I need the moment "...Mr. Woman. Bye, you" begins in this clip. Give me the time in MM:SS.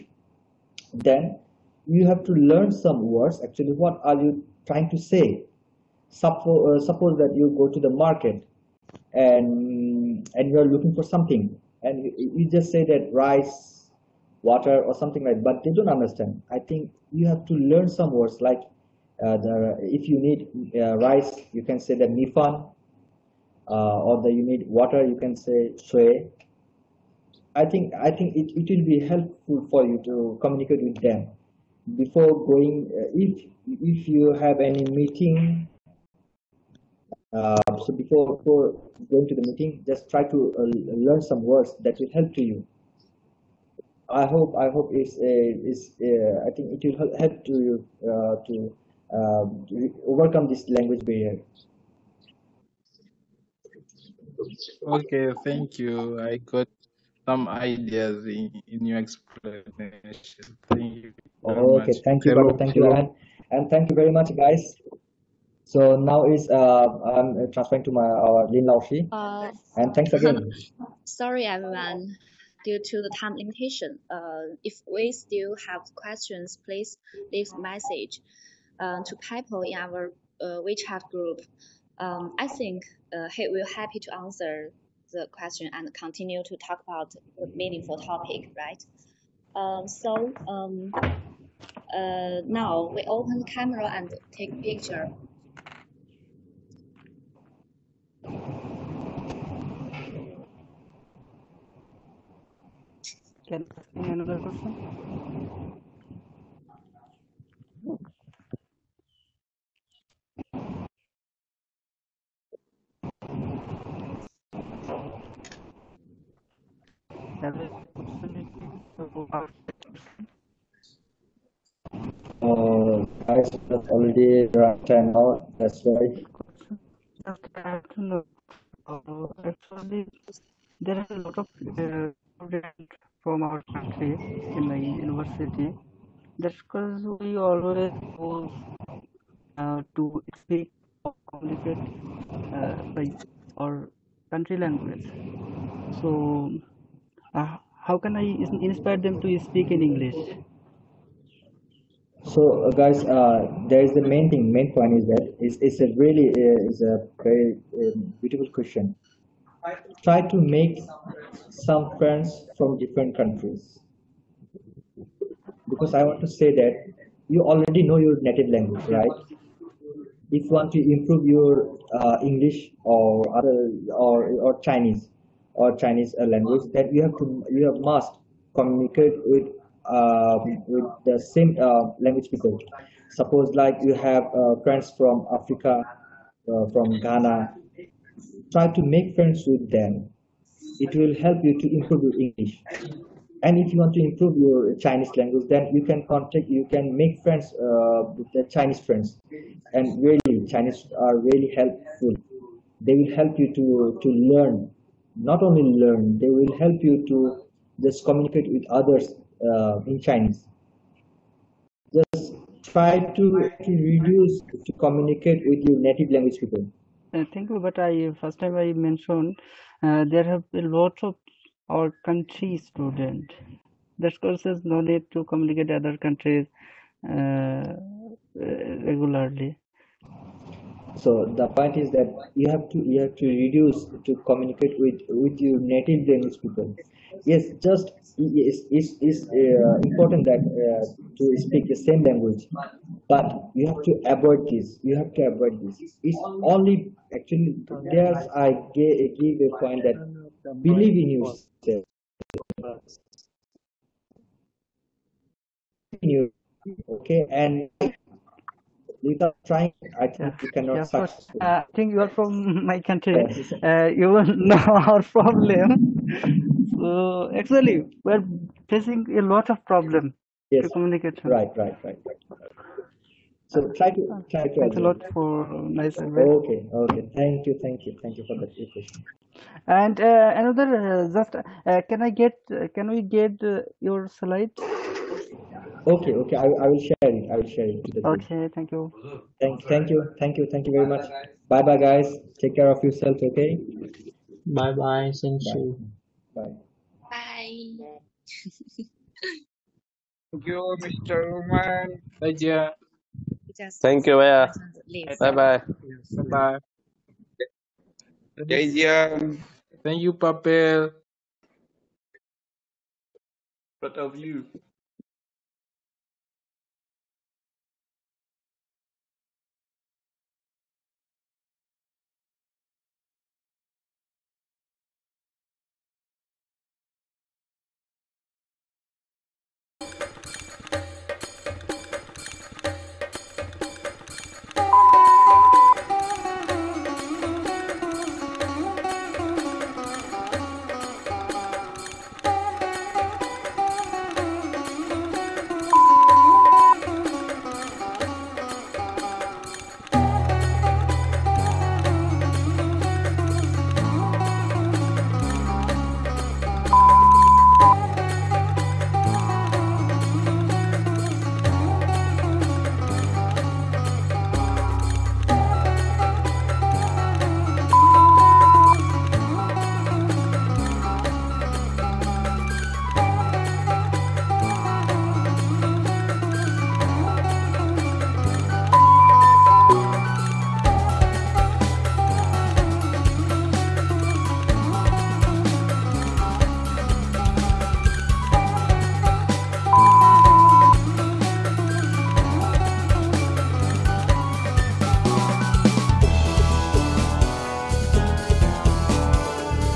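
05:00.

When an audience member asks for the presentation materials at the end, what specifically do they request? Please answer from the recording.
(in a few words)
your slide.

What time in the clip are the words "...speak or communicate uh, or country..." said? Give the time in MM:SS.
02:20.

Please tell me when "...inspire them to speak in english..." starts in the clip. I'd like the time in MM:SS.
02:28.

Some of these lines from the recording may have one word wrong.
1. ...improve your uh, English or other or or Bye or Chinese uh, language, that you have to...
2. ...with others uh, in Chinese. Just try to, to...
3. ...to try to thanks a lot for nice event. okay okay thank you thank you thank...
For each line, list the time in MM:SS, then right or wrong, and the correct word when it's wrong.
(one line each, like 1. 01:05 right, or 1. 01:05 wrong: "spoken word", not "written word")
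1. 02:50 wrong: "Chinese", not "Bye"
2. 03:28 right
3. 04:33 right.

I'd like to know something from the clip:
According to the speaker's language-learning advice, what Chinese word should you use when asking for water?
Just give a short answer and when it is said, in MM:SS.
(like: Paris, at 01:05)
shui, at 00:25.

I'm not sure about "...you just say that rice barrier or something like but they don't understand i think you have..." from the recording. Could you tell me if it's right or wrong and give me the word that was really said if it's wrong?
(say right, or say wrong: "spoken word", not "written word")
wrong: "water", not "barrier".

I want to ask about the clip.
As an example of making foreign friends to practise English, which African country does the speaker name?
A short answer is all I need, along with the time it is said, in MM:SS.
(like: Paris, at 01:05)
Ghana, at 03:06.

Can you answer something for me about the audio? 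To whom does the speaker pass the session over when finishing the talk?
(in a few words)
Lin Laoshi.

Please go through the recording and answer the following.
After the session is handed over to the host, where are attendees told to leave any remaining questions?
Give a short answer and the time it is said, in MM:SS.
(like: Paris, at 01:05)
WeChat group, at 01:20.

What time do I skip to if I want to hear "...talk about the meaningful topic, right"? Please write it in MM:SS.
01:26.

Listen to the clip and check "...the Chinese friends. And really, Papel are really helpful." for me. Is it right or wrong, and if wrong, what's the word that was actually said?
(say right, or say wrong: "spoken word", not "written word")
wrong: "Chinese", not "Papel".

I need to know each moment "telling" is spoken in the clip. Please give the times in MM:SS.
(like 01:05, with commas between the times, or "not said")
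not said.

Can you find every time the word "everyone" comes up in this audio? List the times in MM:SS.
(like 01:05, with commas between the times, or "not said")
01:11.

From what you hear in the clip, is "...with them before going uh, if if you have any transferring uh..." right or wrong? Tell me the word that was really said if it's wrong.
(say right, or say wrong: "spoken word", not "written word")
wrong: "meeting", not "transferring".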